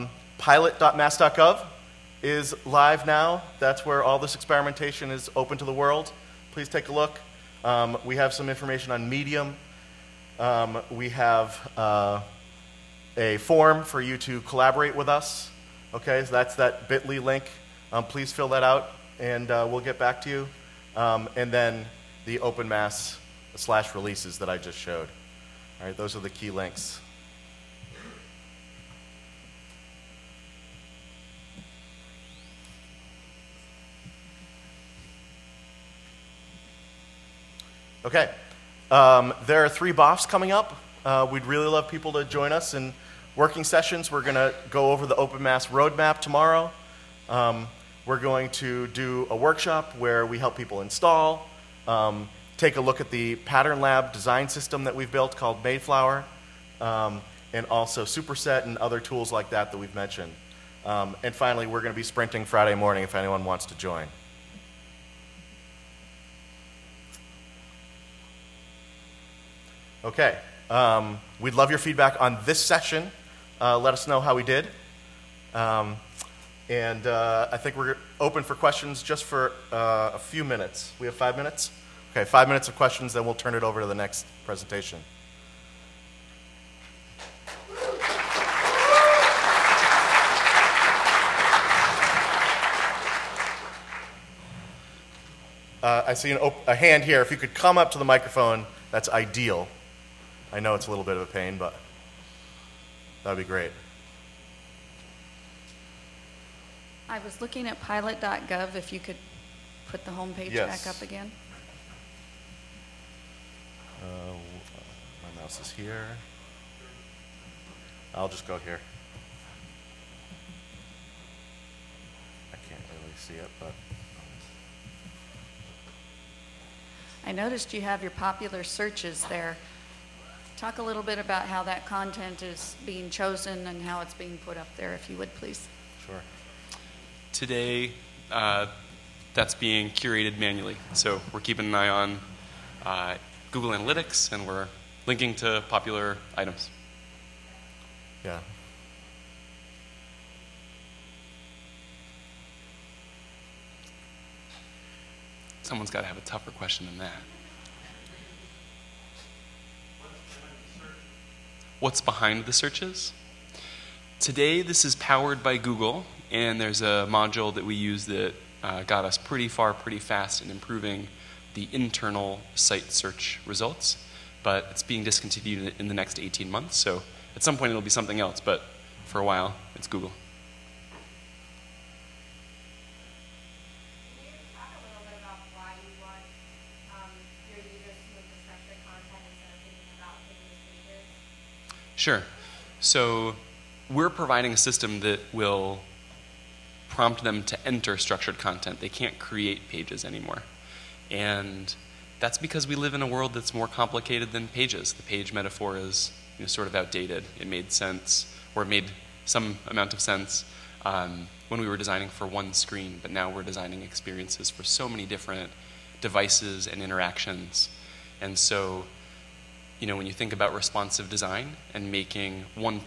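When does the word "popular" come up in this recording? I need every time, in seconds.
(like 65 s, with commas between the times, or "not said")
128 s, 145 s.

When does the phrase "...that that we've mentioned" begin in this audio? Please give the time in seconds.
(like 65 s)
59 s.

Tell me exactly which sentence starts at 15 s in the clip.
Okay, so that's that bit.ly link.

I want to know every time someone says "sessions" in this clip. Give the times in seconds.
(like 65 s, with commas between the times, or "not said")
43 s, 72 s.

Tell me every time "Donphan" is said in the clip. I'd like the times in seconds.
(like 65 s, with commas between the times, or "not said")
not said.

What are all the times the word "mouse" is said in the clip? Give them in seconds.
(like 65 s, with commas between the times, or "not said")
115 s.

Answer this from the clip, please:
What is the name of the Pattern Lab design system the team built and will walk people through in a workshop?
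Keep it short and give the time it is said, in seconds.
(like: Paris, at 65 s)
Mayflower, at 55 s.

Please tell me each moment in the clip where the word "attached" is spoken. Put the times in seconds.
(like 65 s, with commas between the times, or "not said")
not said.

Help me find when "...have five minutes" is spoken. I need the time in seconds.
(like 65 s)
81 s.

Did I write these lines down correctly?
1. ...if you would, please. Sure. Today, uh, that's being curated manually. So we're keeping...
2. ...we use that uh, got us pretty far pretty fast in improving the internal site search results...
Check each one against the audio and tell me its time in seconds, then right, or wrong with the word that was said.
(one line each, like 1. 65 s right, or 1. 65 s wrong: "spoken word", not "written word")
1. 134 s right
2. 167 s right.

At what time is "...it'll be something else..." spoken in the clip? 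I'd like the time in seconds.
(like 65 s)
177 s.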